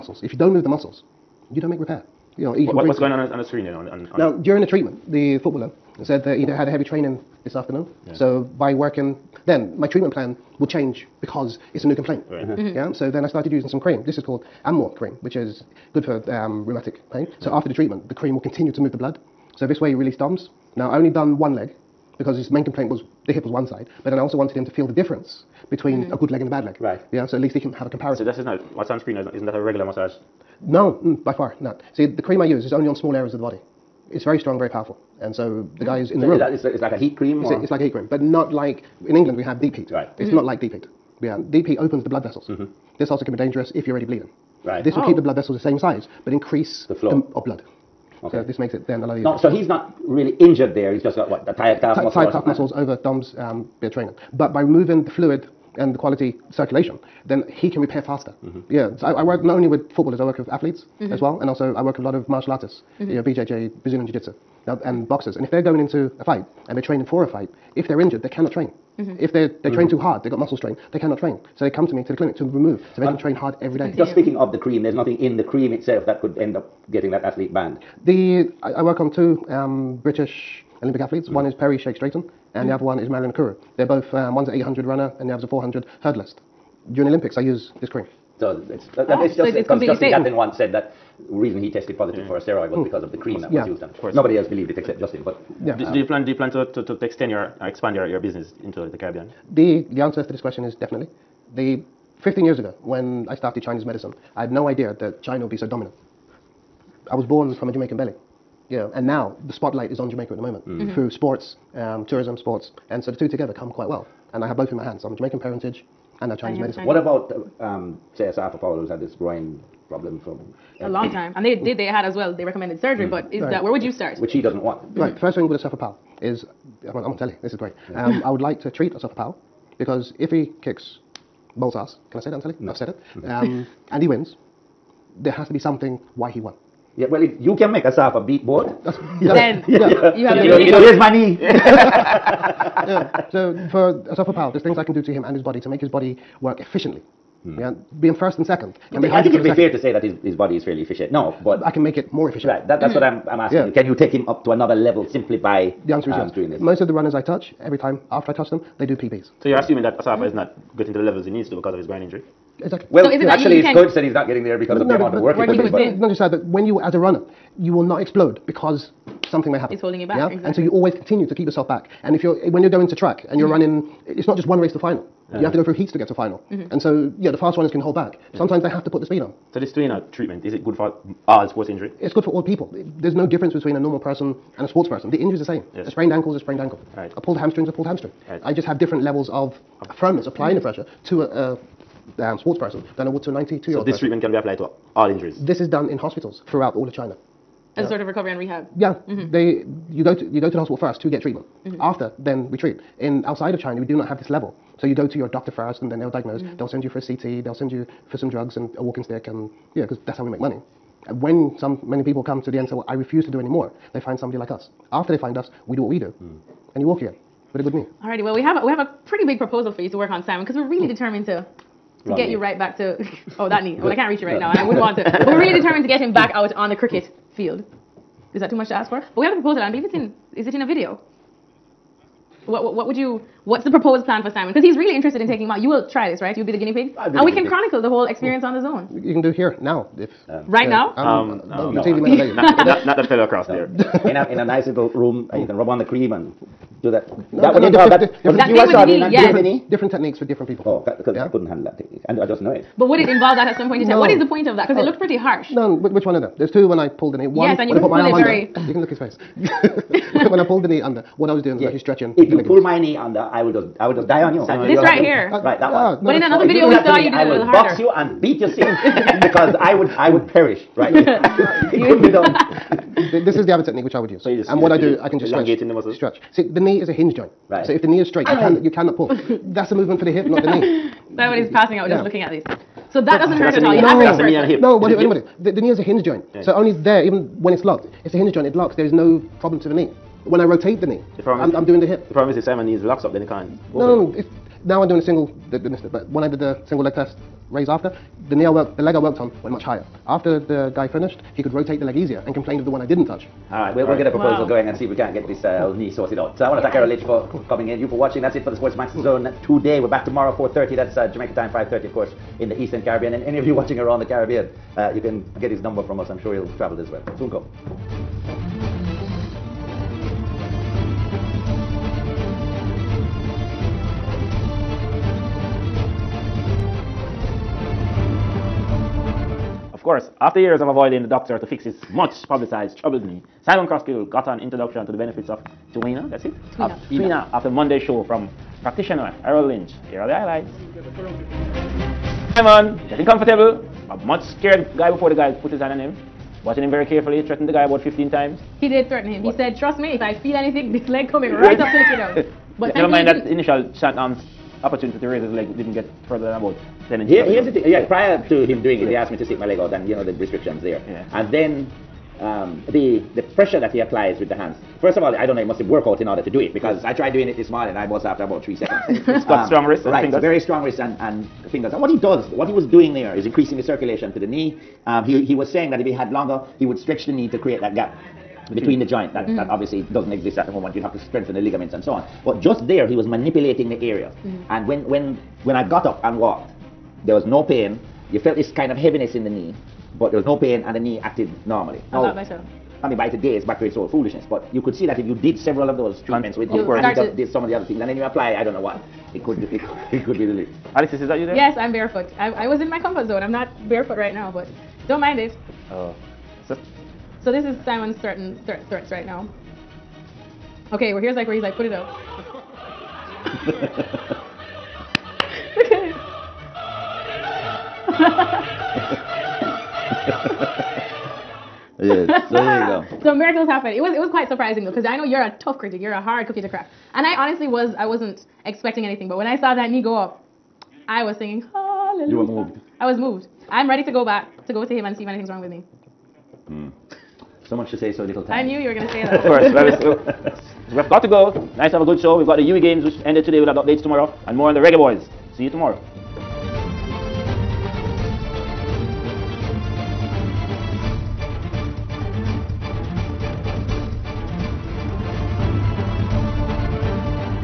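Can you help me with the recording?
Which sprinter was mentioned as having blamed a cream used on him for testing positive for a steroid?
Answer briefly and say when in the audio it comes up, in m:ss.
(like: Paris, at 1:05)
Justin Gatlin, at 1:29.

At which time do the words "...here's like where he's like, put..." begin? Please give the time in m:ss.
6:51.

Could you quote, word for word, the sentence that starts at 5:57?
Yeah, prior to him doing it, yeah.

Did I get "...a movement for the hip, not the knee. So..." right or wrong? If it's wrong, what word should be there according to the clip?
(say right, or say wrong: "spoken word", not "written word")
right.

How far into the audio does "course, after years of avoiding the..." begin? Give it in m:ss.
5:29.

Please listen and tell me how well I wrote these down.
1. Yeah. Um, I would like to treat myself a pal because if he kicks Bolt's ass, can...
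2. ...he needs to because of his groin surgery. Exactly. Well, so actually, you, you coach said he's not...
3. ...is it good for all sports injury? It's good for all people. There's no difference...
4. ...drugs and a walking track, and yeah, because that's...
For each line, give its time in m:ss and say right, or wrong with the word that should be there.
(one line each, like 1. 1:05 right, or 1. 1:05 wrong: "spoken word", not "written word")
1. 2:07 right
2. 2:41 wrong: "injury", not "surgery"
3. 3:00 right
4. 3:28 wrong: "stick", not "track".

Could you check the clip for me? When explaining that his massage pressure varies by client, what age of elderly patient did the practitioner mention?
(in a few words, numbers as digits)
92.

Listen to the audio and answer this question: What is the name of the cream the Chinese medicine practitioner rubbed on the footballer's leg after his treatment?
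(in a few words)
Amor cream.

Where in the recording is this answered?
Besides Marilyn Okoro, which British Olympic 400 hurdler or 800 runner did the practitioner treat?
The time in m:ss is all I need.
1:21.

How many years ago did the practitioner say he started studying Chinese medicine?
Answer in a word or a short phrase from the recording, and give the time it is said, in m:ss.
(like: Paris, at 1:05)
15, at 1:42.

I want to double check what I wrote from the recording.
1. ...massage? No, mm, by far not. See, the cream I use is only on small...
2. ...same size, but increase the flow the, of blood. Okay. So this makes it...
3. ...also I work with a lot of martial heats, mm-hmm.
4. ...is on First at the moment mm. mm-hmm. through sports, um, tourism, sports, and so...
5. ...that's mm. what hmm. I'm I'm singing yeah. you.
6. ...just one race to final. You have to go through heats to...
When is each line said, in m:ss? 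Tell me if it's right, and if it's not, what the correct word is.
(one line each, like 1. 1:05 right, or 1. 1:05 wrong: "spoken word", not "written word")
1. 0:29 right
2. 0:45 right
3. 1:01 wrong: "artists", not "heats"
4. 1:49 wrong: "Jamaica", not "First"
5. 2:32 wrong: "asking", not "singing"
6. 2:54 right.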